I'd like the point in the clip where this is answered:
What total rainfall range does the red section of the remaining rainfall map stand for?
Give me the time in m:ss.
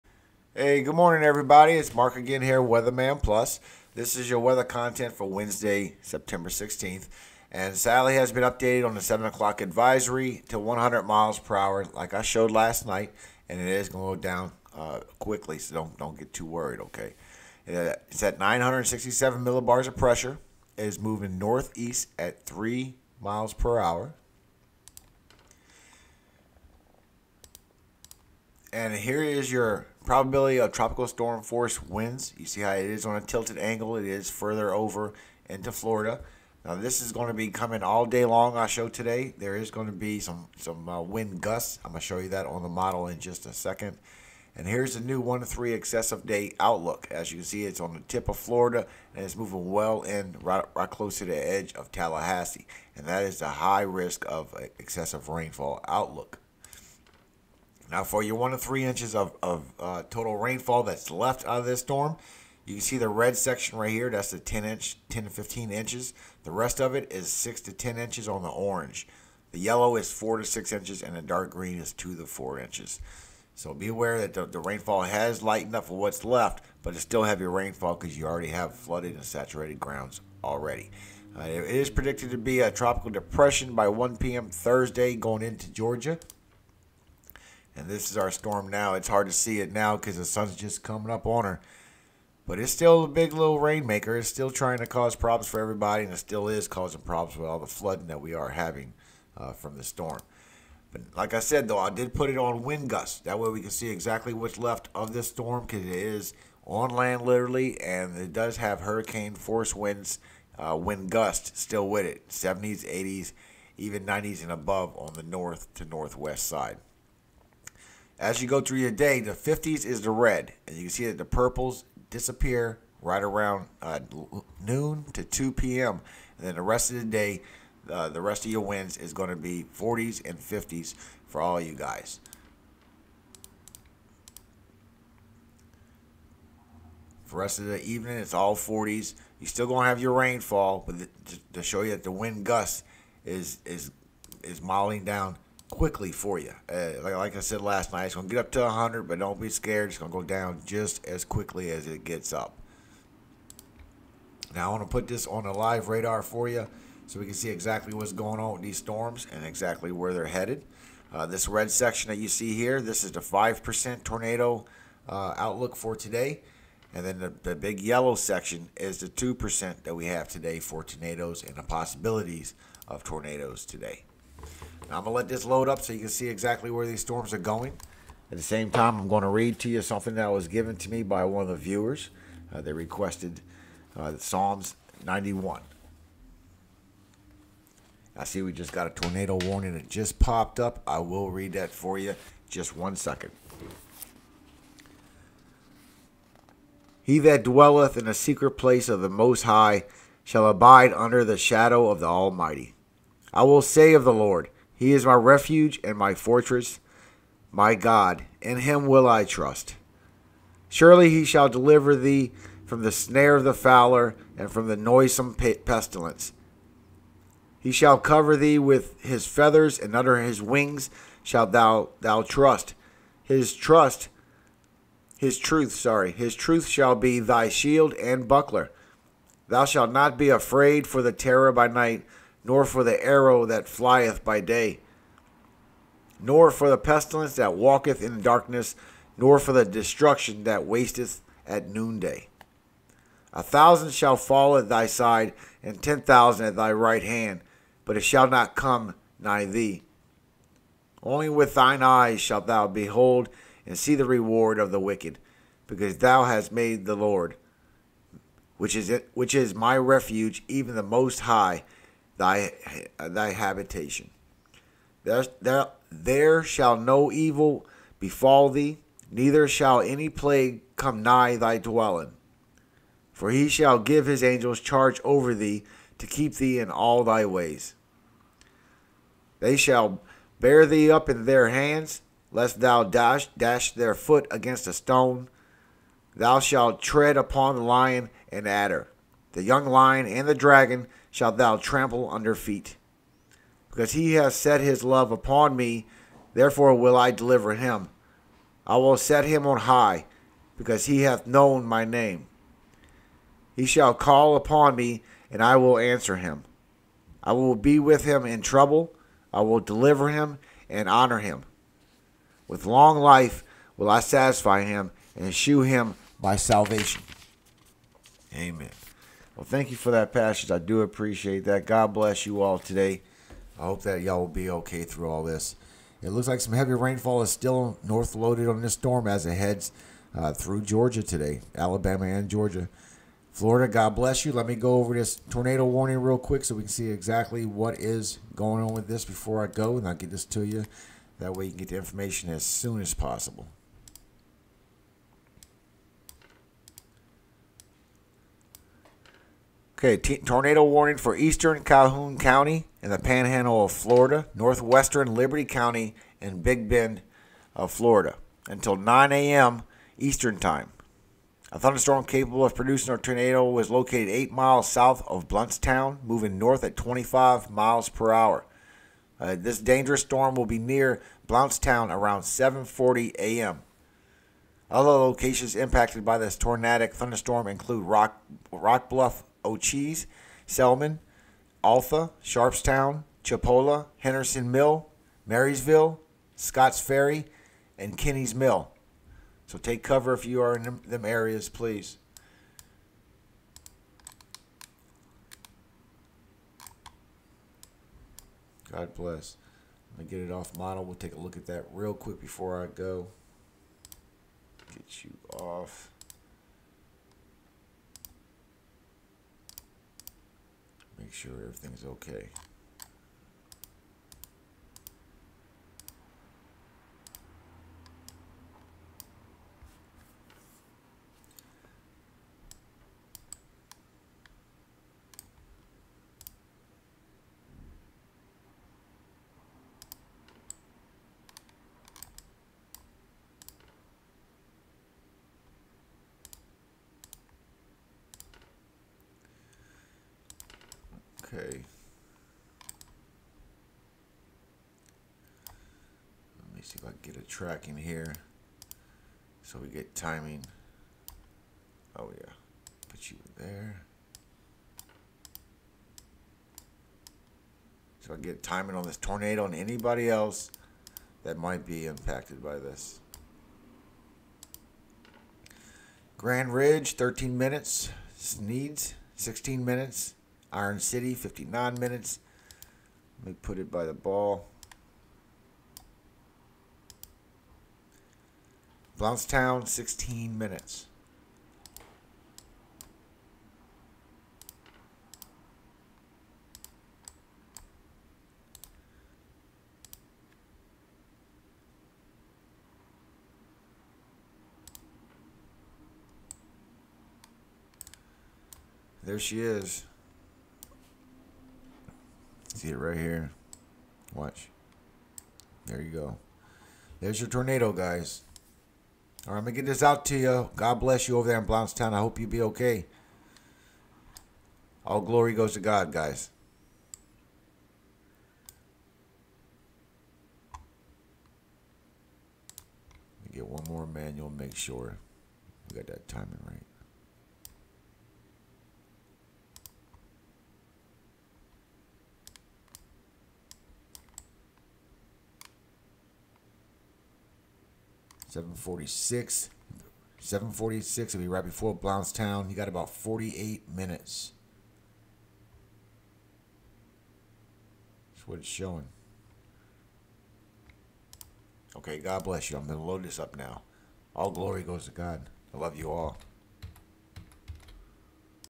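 1:05.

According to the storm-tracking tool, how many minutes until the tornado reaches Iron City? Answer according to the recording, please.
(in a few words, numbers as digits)
59 minutes.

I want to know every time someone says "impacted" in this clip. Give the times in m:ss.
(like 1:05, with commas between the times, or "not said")
6:15, 7:41.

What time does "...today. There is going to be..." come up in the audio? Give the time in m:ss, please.
0:38.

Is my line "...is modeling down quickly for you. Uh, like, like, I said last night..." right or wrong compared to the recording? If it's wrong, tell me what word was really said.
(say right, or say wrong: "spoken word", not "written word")
right.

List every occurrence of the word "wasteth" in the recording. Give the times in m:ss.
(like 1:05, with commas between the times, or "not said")
4:00.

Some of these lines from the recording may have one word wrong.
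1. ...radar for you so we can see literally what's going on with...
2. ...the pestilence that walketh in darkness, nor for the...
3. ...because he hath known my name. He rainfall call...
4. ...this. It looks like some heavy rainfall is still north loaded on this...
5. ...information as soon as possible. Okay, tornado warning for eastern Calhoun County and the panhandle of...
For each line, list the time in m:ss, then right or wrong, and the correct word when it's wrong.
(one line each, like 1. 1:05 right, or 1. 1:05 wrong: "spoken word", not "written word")
1. 2:35 wrong: "exactly", not "literally"
2. 3:56 right
3. 5:00 wrong: "shall", not "rainfall"
4. 5:25 right
5. 5:41 right.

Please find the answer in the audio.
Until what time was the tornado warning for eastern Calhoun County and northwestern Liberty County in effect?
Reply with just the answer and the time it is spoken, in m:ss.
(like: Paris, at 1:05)
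9 a.m. Eastern, at 5:58.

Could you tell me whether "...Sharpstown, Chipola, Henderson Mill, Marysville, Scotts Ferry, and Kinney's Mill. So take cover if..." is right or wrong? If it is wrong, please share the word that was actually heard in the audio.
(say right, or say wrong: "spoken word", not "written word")
right.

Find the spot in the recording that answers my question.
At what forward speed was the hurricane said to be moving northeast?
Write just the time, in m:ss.
0:22.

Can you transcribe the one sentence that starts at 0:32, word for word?
You see how it is on a tilted angle.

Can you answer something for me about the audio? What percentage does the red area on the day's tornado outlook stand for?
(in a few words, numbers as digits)
5%.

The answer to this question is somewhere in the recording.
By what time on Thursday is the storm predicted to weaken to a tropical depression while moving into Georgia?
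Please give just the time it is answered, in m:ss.
1:23.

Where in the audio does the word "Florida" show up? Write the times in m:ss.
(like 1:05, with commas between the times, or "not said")
0:35, 0:48, 5:33, 5:53, 5:57.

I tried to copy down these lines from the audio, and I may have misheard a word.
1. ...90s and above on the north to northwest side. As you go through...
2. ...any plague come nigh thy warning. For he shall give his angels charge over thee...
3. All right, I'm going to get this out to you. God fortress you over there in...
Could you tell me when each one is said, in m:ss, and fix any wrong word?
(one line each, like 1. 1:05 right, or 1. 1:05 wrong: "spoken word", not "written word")
1. 1:54 right
2. 4:29 wrong: "dwelling", not "warning"
3. 8:29 wrong: "bless", not "fortress".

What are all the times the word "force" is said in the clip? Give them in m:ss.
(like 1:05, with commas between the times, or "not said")
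0:31, 1:49.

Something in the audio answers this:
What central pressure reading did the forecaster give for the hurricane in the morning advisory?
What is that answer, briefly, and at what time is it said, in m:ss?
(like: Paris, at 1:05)
967 millibars, at 0:18.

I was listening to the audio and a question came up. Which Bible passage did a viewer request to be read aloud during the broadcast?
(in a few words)
Psalms 91.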